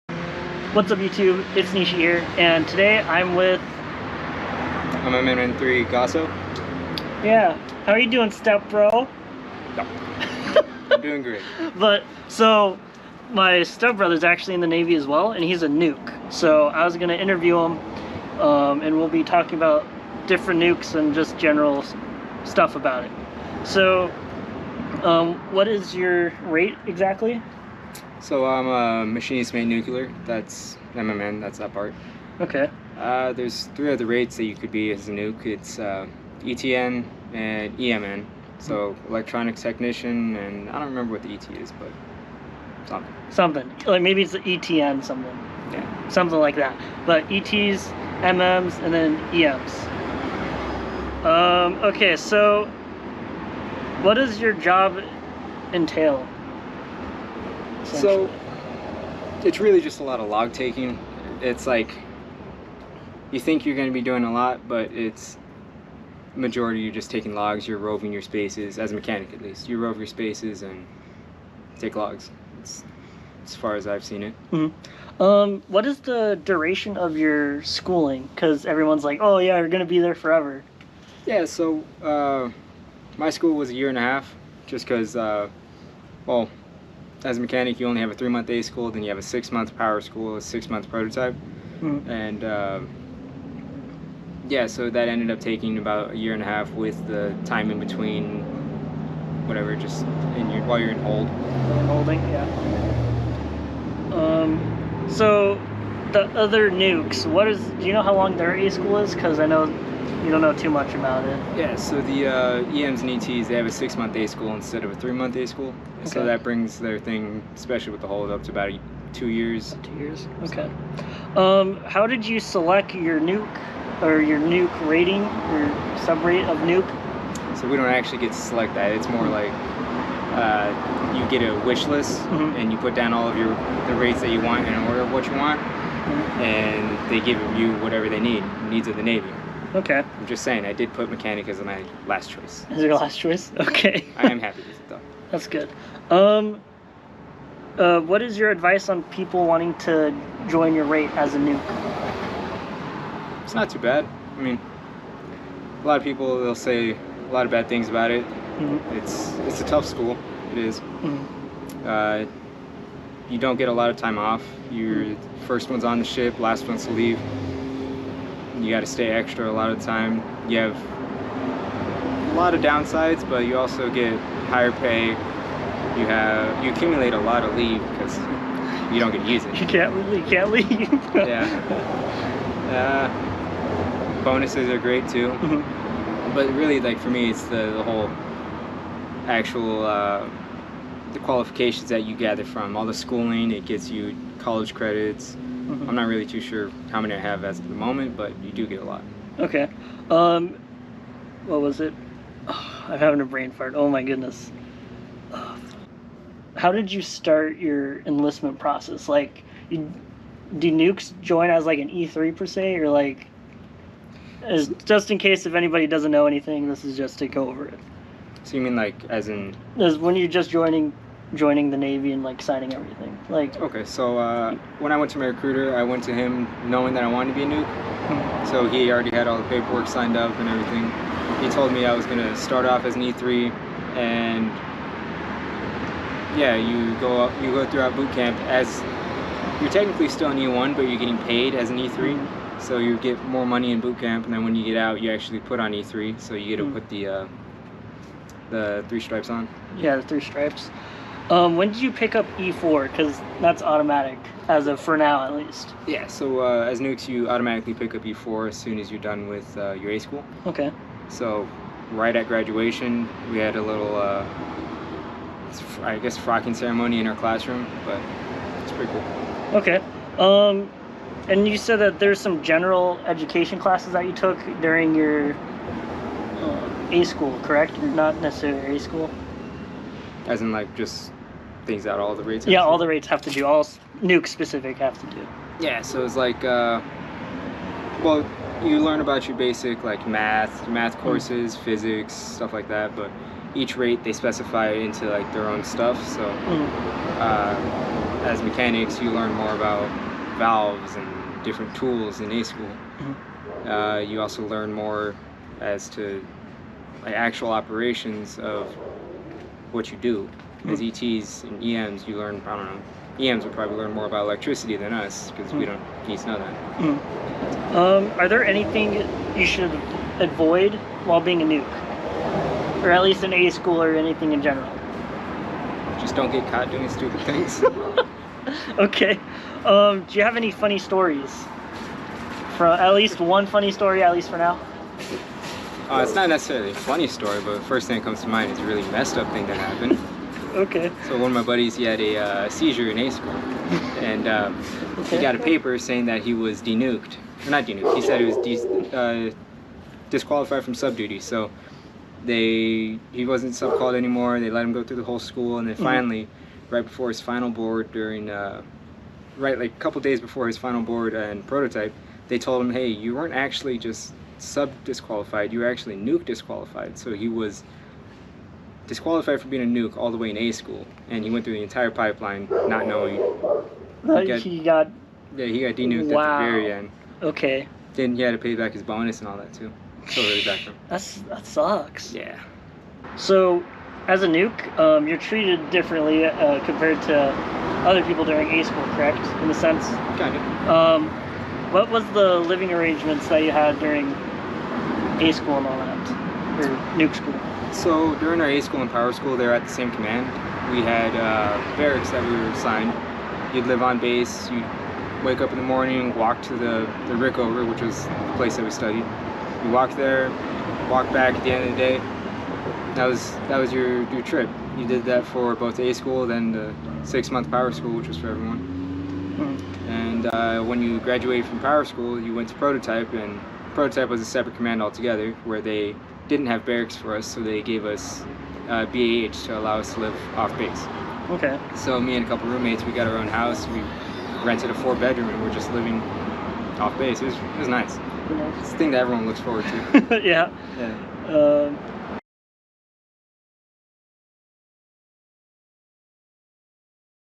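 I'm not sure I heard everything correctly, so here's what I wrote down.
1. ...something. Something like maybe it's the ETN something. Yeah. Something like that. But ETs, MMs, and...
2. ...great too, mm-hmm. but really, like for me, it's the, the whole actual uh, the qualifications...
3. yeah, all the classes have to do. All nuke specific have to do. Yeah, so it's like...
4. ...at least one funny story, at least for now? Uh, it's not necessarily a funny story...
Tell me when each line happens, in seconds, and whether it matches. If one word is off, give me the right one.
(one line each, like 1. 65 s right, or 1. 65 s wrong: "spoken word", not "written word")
1. 42 s right
2. 184 s right
3. 282 s wrong: "rates", not "classes"
4. 332 s right.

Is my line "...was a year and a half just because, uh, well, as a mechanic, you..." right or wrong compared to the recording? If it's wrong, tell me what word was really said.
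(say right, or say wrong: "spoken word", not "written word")
right.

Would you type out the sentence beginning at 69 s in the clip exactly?
You rove your spaces and take logs.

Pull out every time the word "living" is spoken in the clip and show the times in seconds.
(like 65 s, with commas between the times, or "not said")
392 s, 435 s.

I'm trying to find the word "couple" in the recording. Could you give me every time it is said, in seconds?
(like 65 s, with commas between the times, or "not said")
359 s, 432 s.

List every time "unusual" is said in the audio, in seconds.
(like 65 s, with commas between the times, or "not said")
not said.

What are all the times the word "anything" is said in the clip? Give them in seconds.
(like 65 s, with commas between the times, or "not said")
216 s, 318 s, 323 s.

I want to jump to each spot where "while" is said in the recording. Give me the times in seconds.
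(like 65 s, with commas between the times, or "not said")
100 s, 321 s.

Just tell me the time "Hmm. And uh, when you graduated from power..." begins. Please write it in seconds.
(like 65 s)
419 s.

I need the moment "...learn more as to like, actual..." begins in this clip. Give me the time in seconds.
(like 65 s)
304 s.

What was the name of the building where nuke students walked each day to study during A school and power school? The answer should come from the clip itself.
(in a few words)
the Rick.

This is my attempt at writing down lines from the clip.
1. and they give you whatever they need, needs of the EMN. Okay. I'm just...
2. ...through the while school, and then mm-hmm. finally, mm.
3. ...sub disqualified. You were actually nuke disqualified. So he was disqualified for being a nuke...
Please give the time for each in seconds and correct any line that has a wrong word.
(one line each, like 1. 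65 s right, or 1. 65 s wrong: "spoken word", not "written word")
1. 136 s wrong: "Navy", not "EMN"
2. 354 s wrong: "whole", not "while"
3. 364 s right.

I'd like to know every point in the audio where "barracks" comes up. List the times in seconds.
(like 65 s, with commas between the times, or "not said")
401 s, 426 s.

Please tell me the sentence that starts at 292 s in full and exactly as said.
But each rate they specify into like their own stuff.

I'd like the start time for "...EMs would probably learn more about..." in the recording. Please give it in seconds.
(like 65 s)
313 s.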